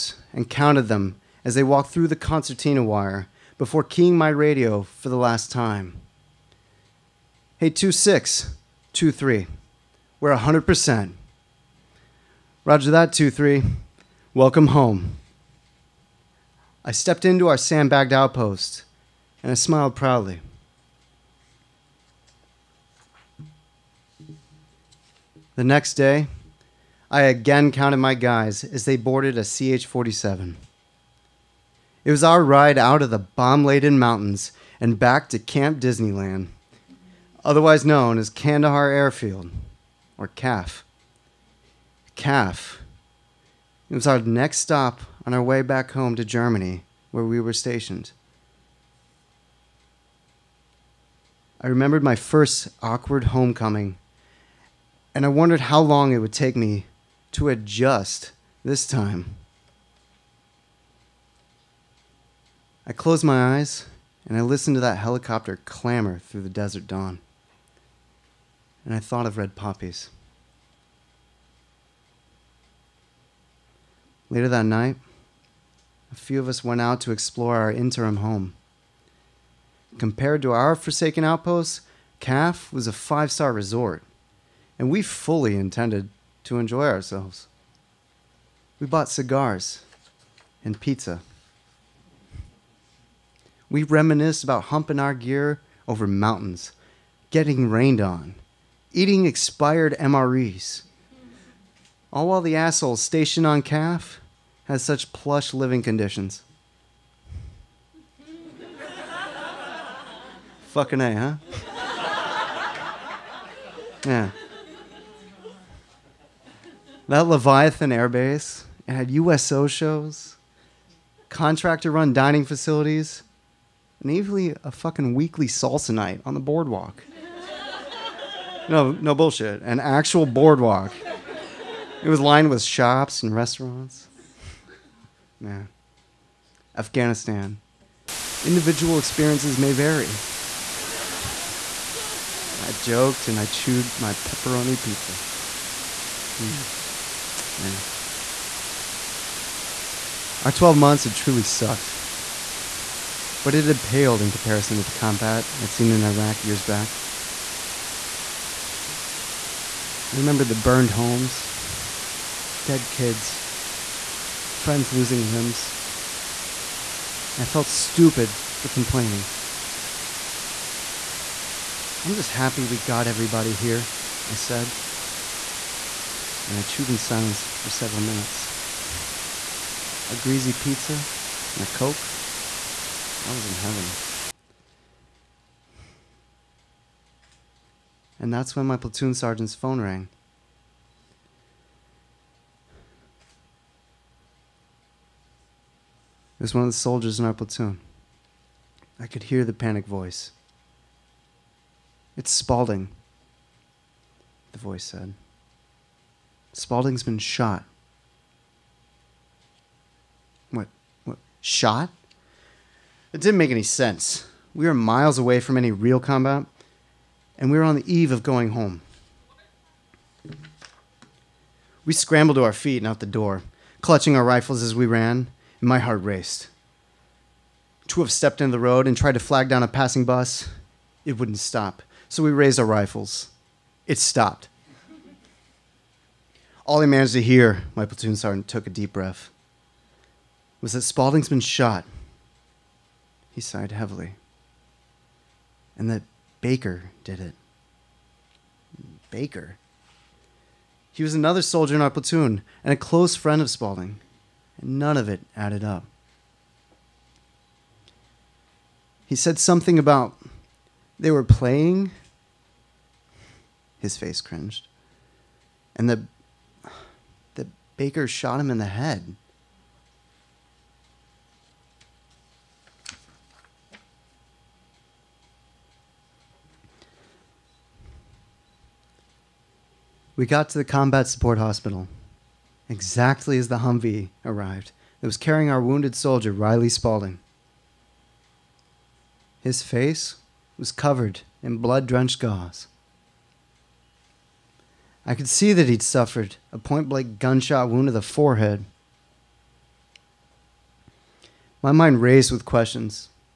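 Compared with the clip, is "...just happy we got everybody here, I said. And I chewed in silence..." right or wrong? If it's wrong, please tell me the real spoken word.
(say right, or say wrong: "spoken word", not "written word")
right.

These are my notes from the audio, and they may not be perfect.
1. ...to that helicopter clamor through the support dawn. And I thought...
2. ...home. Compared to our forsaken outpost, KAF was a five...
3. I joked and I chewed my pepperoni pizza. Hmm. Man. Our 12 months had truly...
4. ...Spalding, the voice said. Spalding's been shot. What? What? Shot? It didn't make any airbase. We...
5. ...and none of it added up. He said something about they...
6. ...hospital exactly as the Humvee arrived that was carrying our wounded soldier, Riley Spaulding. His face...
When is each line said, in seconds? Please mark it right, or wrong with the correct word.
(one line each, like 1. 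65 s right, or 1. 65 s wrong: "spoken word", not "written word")
1. 64 s wrong: "desert", not "support"
2. 78 s right
3. 142 s right
4. 202 s wrong: "sense", not "airbase"
5. 254 s right
6. 281 s right.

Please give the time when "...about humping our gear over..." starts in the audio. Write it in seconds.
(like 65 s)
94 s.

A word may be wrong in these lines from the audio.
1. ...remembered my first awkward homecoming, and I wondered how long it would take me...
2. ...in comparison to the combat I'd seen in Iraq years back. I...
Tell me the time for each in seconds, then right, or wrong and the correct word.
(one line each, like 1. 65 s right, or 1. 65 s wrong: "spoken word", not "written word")
1. 51 s right
2. 154 s right.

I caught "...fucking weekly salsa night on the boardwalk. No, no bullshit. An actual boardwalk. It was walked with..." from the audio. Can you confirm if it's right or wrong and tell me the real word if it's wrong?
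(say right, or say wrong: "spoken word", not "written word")
wrong: "lined", not "walked".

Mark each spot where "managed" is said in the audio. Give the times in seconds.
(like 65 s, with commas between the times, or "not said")
236 s.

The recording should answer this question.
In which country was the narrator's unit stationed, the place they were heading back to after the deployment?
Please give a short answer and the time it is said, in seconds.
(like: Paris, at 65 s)
Germany, at 46 s.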